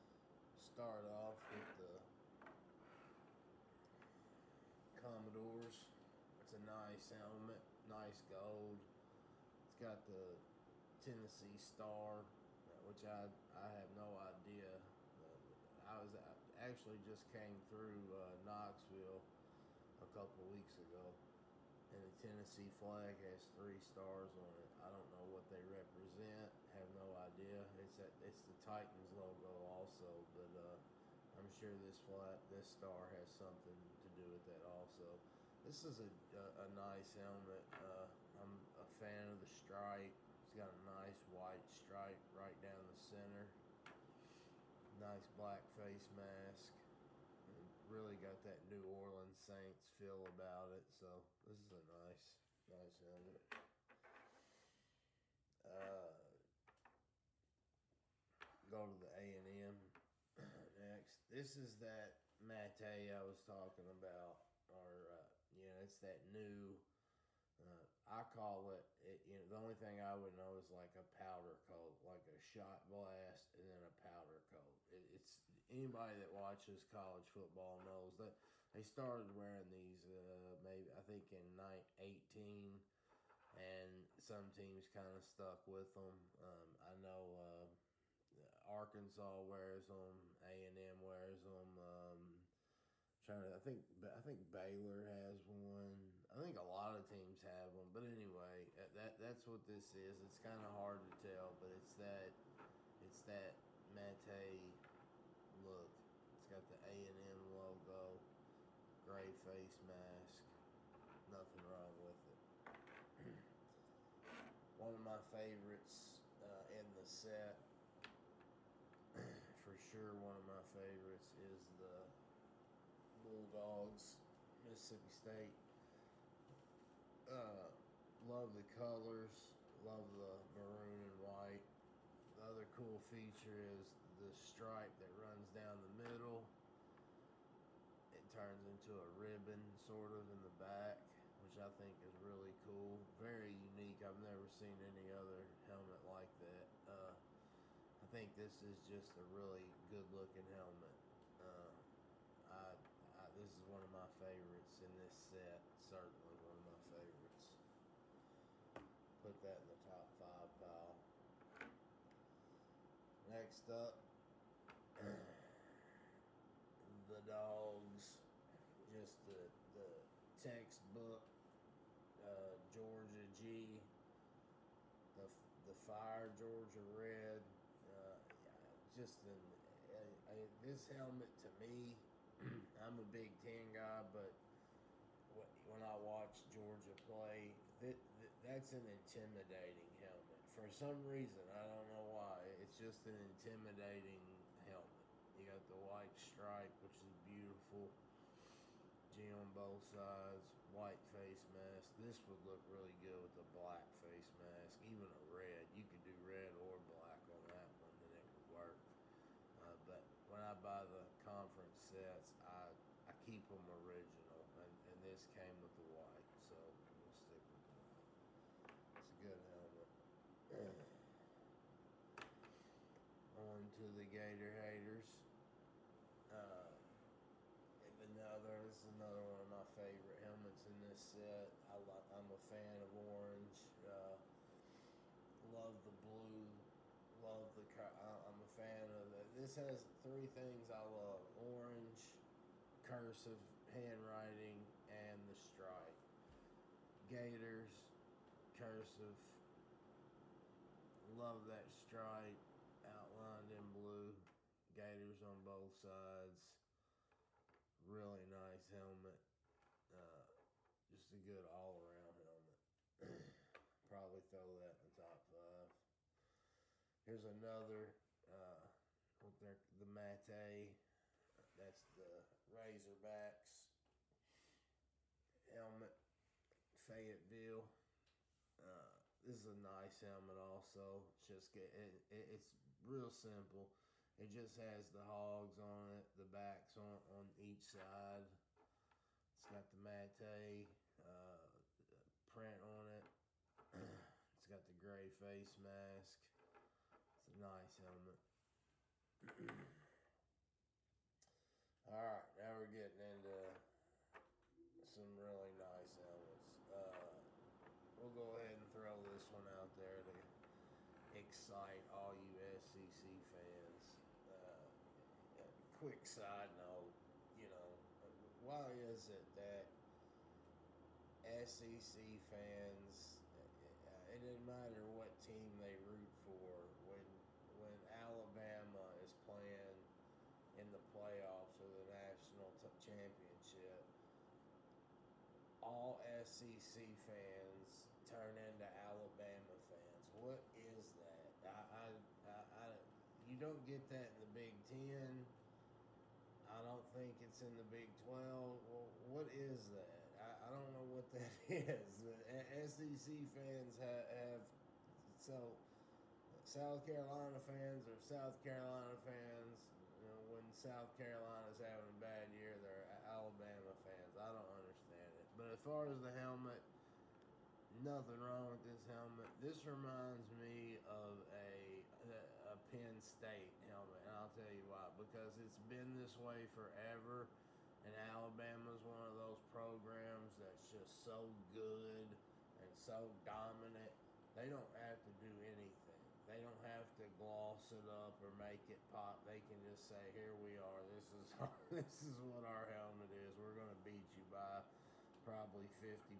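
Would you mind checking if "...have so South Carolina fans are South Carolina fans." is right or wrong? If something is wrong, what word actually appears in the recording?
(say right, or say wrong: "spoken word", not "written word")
right.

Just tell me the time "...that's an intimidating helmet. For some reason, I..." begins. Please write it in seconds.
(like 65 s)
188 s.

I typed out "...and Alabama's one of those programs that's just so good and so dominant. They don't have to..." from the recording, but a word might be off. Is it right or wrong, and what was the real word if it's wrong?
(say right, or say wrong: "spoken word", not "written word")
right.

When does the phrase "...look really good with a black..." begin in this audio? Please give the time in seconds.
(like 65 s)
202 s.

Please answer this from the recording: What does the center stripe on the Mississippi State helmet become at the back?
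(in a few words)
a ribbon.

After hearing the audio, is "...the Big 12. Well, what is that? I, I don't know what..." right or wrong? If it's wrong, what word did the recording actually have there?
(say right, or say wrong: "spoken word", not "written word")
right.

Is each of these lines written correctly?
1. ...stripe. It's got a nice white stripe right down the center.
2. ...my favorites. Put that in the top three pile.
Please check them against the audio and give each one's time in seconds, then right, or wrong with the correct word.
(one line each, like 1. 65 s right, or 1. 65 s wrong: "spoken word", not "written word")
1. 39 s right
2. 156 s wrong: "five", not "three".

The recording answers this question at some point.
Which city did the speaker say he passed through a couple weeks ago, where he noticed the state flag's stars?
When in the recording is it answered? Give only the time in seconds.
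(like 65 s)
18 s.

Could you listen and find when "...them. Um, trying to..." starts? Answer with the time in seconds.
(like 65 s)
91 s.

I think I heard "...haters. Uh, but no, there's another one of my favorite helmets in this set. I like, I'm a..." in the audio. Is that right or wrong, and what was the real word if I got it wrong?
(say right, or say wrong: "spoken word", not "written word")
right.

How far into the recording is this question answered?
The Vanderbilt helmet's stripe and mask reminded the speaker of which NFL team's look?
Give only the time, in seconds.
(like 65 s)
48 s.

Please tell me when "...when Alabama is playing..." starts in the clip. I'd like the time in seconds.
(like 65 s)
327 s.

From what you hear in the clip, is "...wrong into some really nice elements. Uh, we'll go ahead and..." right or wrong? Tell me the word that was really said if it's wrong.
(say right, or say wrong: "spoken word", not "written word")
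wrong: "getting", not "wrong".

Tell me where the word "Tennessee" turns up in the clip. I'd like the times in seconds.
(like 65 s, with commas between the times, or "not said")
11 s, 22 s.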